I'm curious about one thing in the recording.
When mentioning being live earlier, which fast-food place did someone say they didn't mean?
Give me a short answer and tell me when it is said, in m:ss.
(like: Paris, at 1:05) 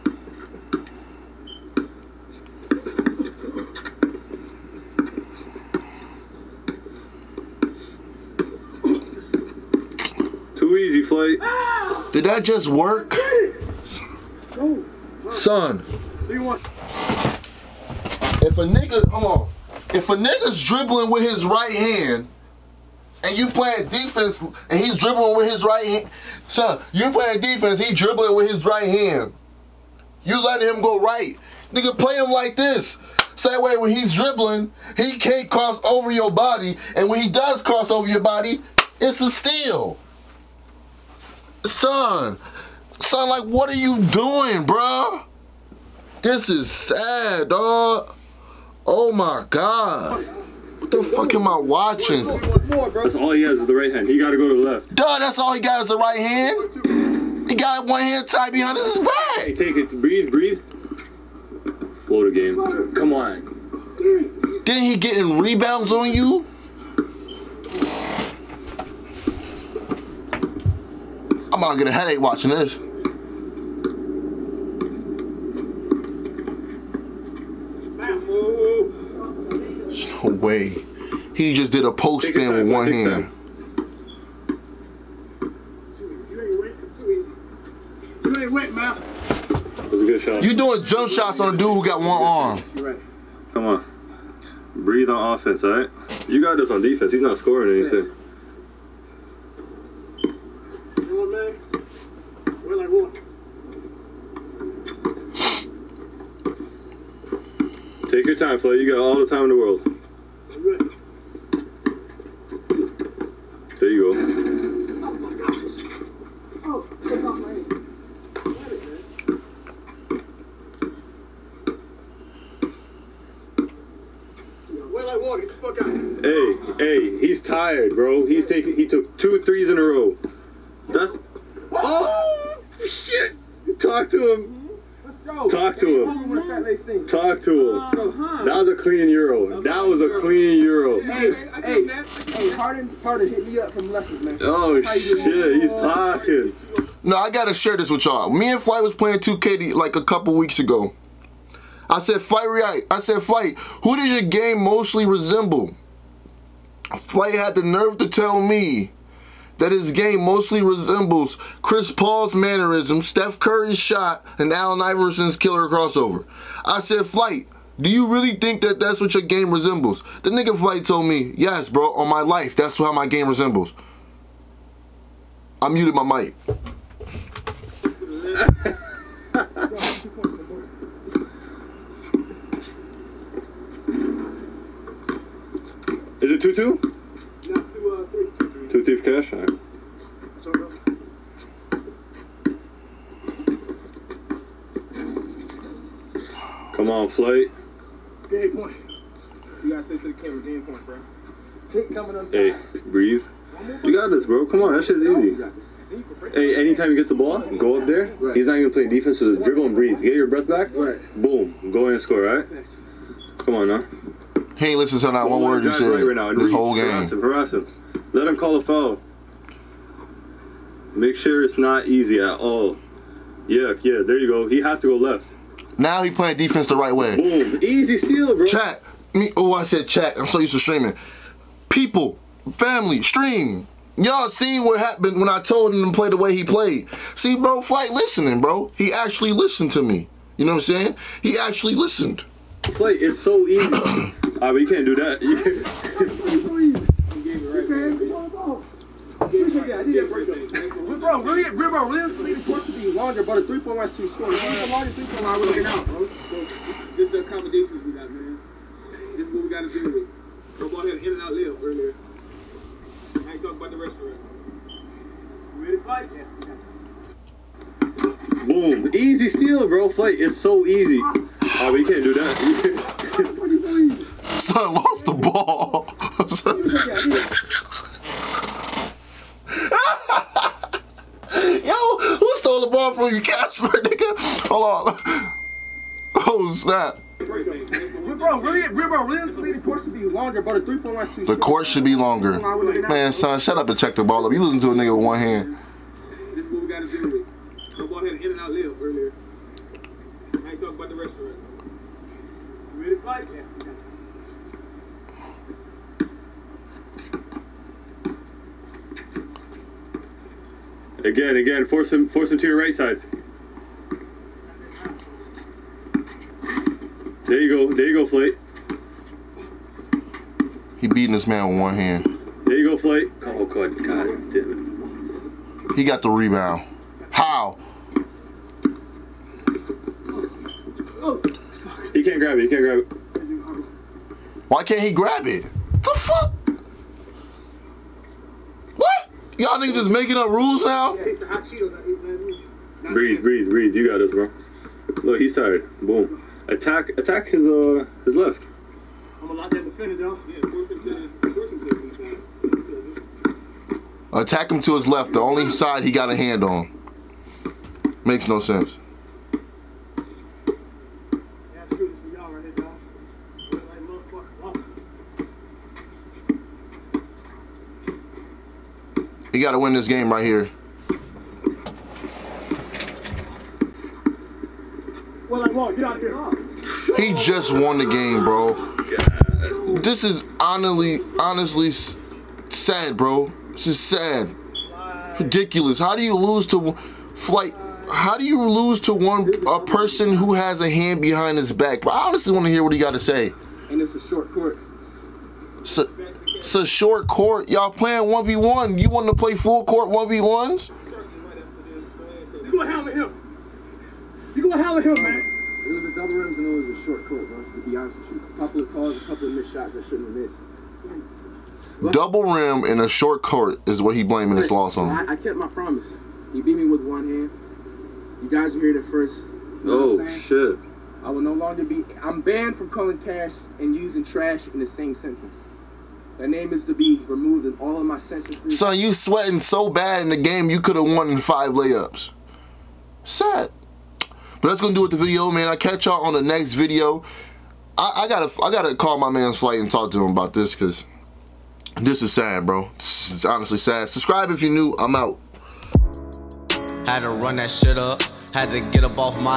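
In and out, at 4:21.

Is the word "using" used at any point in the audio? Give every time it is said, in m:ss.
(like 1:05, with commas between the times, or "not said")
7:03.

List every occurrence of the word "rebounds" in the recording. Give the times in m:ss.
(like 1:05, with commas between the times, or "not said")
1:05, 5:26.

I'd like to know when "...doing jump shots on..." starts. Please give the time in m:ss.
1:30.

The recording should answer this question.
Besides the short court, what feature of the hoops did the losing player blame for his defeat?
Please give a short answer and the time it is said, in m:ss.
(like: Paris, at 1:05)
Double rims, at 6:45.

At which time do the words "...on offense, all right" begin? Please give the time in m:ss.
1:35.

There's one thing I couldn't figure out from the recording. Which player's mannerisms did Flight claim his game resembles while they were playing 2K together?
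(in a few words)
Chris Paul.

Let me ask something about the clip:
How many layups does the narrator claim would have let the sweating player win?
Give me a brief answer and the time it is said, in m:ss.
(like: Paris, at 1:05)
5, at 7:11.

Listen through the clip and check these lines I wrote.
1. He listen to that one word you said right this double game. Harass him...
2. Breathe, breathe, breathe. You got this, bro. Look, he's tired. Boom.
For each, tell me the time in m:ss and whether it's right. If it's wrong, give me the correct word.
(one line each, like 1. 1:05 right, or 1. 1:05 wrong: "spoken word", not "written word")
1. 3:34 wrong: "whole", not "double"
2. 5:40 right.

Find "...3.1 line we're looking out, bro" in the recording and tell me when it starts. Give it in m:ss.
4:14.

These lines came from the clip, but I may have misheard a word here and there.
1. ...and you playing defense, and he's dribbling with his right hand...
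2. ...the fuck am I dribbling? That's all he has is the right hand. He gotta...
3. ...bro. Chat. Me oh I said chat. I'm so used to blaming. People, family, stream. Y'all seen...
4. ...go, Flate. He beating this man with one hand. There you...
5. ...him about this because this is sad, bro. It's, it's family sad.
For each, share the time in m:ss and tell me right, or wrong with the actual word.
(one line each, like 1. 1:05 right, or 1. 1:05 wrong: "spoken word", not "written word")
1. 0:23 right
2. 0:50 wrong: "watching", not "dribbling"
3. 3:48 wrong: "streaming", not "blaming"
4. 5:17 right
5. 7:20 wrong: "honestly", not "family".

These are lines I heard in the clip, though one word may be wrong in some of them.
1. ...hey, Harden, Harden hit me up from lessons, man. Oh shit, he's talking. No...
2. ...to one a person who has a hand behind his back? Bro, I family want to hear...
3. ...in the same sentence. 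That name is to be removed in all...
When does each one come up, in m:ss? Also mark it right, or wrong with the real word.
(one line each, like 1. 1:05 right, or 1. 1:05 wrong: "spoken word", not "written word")
1. 2:22 right
2. 6:28 wrong: "honestly", not "family"
3. 7:04 right.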